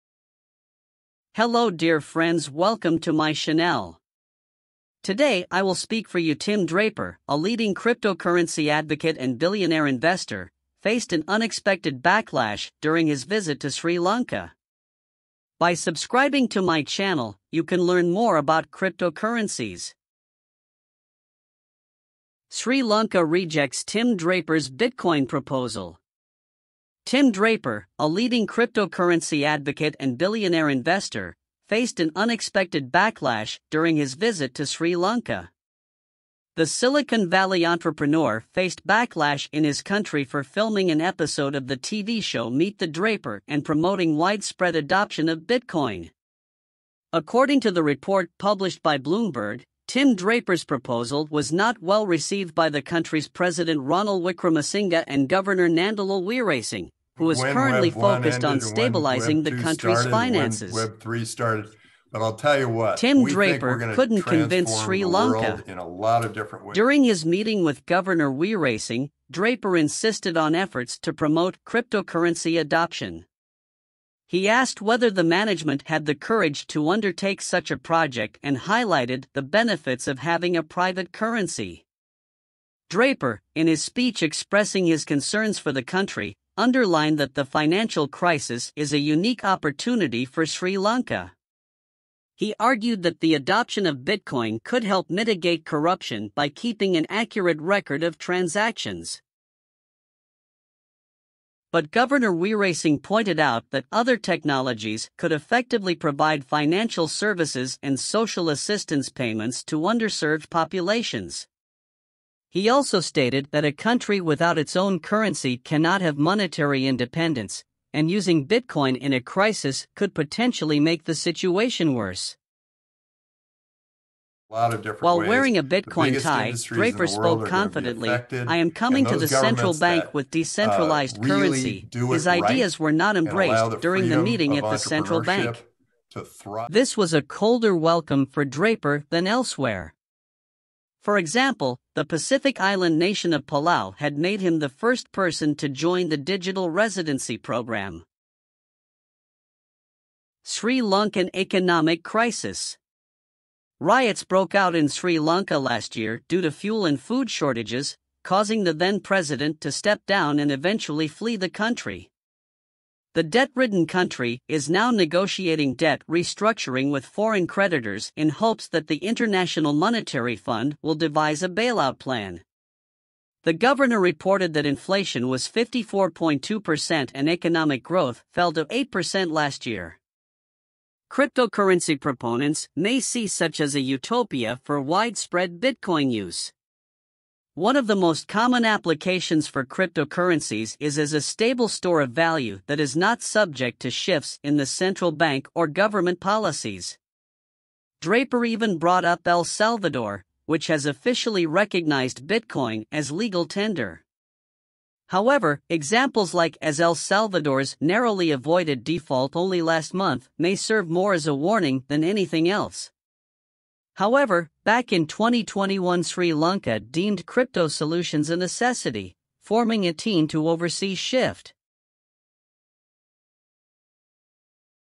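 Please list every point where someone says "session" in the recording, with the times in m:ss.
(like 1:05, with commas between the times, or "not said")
not said.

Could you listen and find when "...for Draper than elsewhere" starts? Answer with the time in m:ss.
2:18.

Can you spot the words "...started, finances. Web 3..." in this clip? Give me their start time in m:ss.
0:59.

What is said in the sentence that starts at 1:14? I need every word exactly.
He asked whether the management had the courage to undertake such a project and highlighted the benefits of having a private currency.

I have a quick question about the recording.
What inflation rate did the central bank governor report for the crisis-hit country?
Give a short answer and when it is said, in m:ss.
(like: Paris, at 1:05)
54.2%, at 2:55.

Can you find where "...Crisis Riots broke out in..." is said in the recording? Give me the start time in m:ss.
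2:32.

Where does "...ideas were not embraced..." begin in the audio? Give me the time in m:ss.
2:12.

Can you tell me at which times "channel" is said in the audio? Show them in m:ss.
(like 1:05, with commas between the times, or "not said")
0:03, 0:16.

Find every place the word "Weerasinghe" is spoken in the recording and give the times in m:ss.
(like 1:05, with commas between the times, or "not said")
0:56, 1:08, 1:42.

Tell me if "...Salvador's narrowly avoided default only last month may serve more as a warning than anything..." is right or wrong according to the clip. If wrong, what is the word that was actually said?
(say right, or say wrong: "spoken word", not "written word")
right.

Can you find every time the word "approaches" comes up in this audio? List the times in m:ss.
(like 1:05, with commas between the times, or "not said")
not said.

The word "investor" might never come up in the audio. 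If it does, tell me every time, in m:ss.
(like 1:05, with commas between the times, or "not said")
0:09, 0:30.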